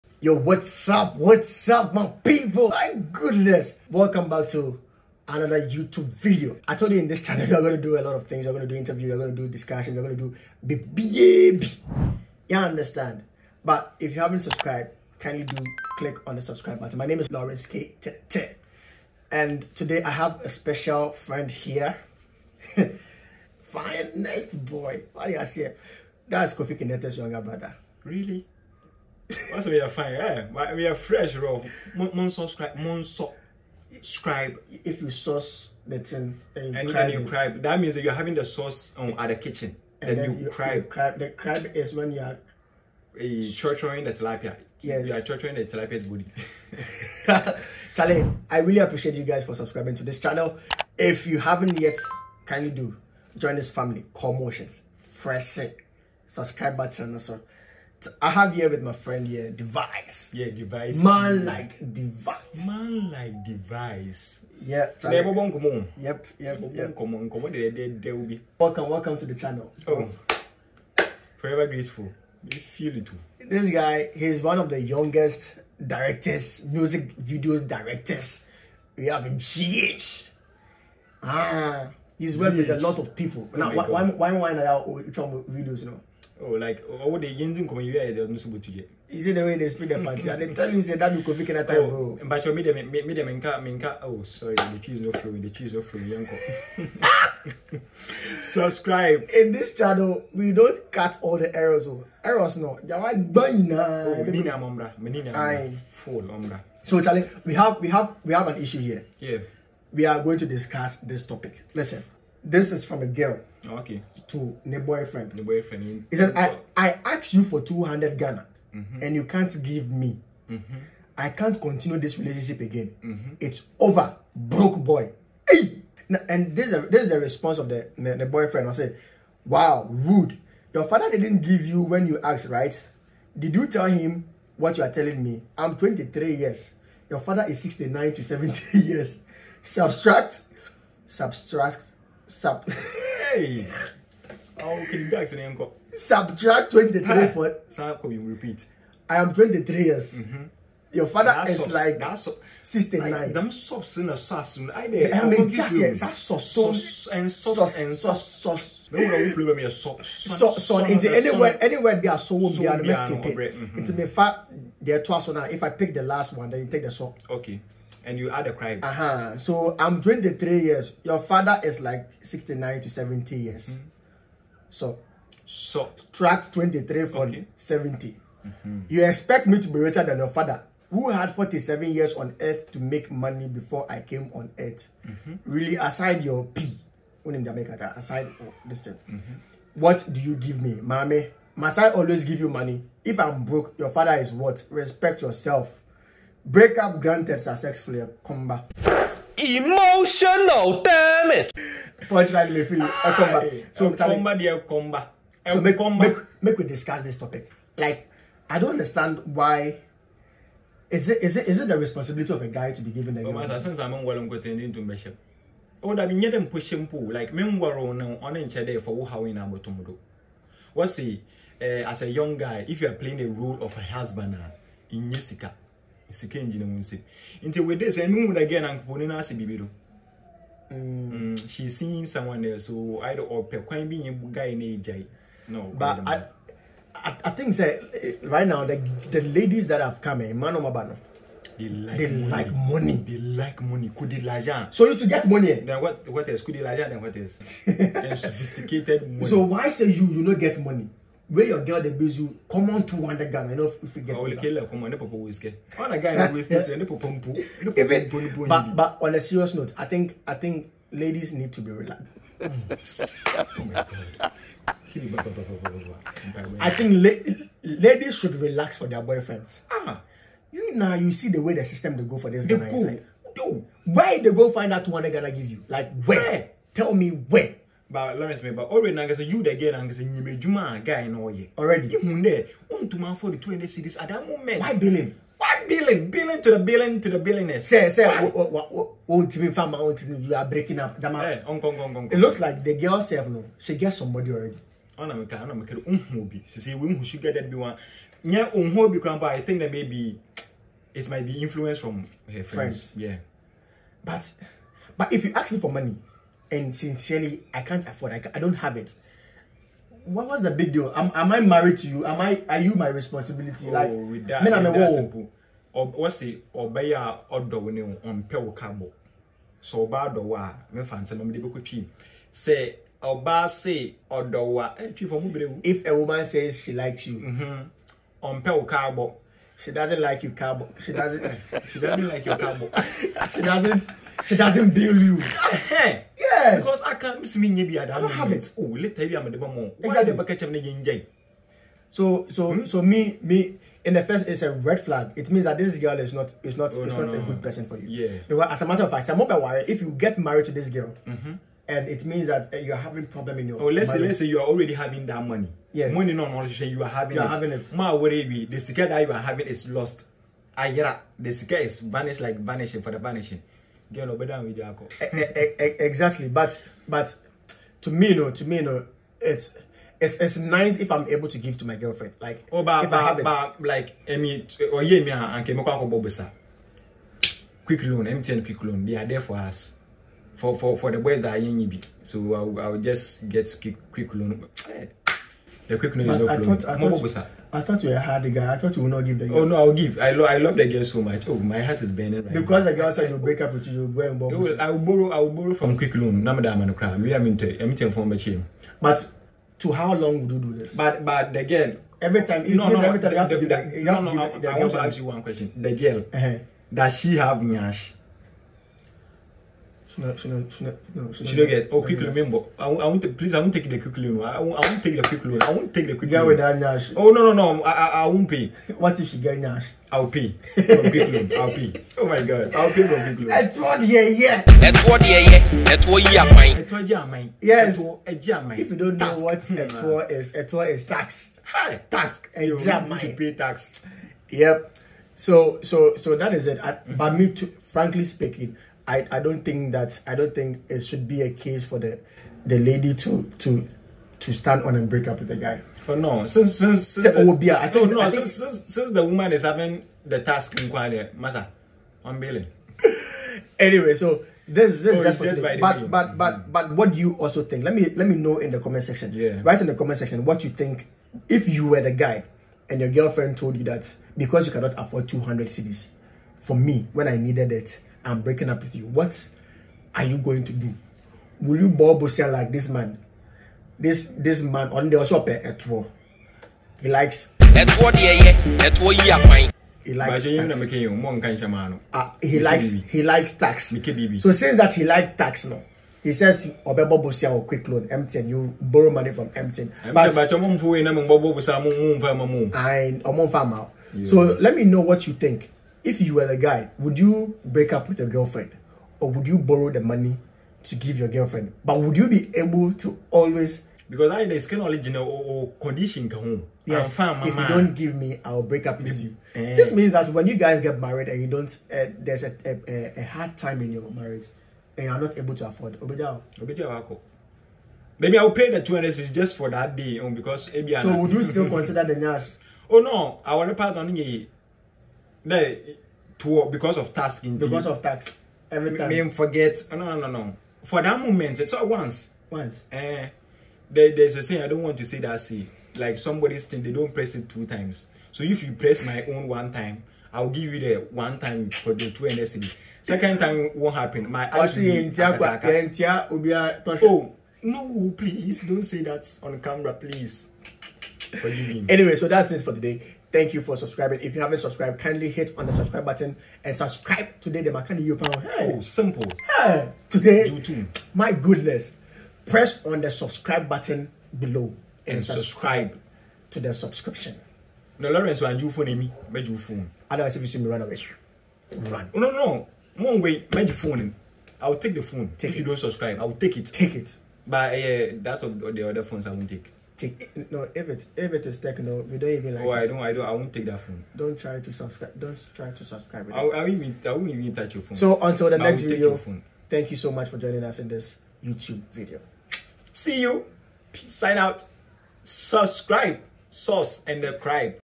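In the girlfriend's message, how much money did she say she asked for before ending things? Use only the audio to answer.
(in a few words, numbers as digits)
200 Ghana.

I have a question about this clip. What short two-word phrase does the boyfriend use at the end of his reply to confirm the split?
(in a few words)
Breakup granted.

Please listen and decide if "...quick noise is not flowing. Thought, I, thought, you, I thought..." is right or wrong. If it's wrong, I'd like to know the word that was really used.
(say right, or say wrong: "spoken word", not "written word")
right.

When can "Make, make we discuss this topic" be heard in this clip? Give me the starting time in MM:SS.
03:25.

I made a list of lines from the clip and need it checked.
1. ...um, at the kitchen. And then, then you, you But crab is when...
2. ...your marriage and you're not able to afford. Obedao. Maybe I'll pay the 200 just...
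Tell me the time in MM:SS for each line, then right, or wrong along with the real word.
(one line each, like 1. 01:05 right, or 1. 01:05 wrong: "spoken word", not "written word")
1. 00:38 wrong: "The", not "But"
2. 08:33 right.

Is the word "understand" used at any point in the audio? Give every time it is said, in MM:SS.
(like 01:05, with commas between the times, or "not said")
00:12, 03:28.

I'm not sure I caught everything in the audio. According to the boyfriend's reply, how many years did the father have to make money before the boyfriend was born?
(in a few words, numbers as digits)
47.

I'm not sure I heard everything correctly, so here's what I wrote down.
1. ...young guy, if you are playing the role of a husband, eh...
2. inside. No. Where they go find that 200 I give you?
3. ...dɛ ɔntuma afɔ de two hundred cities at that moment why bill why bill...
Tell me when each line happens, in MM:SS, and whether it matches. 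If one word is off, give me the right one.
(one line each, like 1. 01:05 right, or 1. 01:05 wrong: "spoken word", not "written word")
1. 03:42 right
2. 04:32 right
3. 04:42 right.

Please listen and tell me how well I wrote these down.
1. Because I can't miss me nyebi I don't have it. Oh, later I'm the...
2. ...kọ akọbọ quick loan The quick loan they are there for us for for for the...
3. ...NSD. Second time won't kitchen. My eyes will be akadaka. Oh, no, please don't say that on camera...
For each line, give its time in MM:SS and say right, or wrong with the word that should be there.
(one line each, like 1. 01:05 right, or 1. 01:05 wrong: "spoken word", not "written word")
1. 05:36 right
2. 06:15 wrong: "MTN", not "The"
3. 09:02 wrong: "happen", not "kitchen".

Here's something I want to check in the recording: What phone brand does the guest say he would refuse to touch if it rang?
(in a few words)
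Techno.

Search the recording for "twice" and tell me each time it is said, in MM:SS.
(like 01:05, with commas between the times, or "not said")
02:45.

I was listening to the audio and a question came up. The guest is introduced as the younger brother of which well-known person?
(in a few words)
Kofi Kinaata.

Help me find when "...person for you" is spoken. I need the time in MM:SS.
05:47.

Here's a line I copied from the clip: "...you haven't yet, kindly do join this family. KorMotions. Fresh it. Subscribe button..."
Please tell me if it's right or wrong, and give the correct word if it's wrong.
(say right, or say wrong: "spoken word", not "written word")
right.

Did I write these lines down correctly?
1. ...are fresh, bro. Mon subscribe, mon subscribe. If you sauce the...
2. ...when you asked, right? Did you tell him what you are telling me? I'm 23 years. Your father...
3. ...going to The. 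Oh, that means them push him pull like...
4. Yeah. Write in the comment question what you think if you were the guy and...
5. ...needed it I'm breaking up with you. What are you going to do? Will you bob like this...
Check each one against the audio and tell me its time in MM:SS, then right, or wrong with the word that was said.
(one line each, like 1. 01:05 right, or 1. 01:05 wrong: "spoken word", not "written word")
1. 00:30 right
2. 02:11 right
3. 03:34 wrong: "Bishop", not "The"
4. 07:39 wrong: "section", not "question"
5. 07:47 right.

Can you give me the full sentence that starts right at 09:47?
So until the but next video, thank you so much for joining us in this YouTube video.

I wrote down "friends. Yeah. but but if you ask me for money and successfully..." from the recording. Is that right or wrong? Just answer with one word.
wrong.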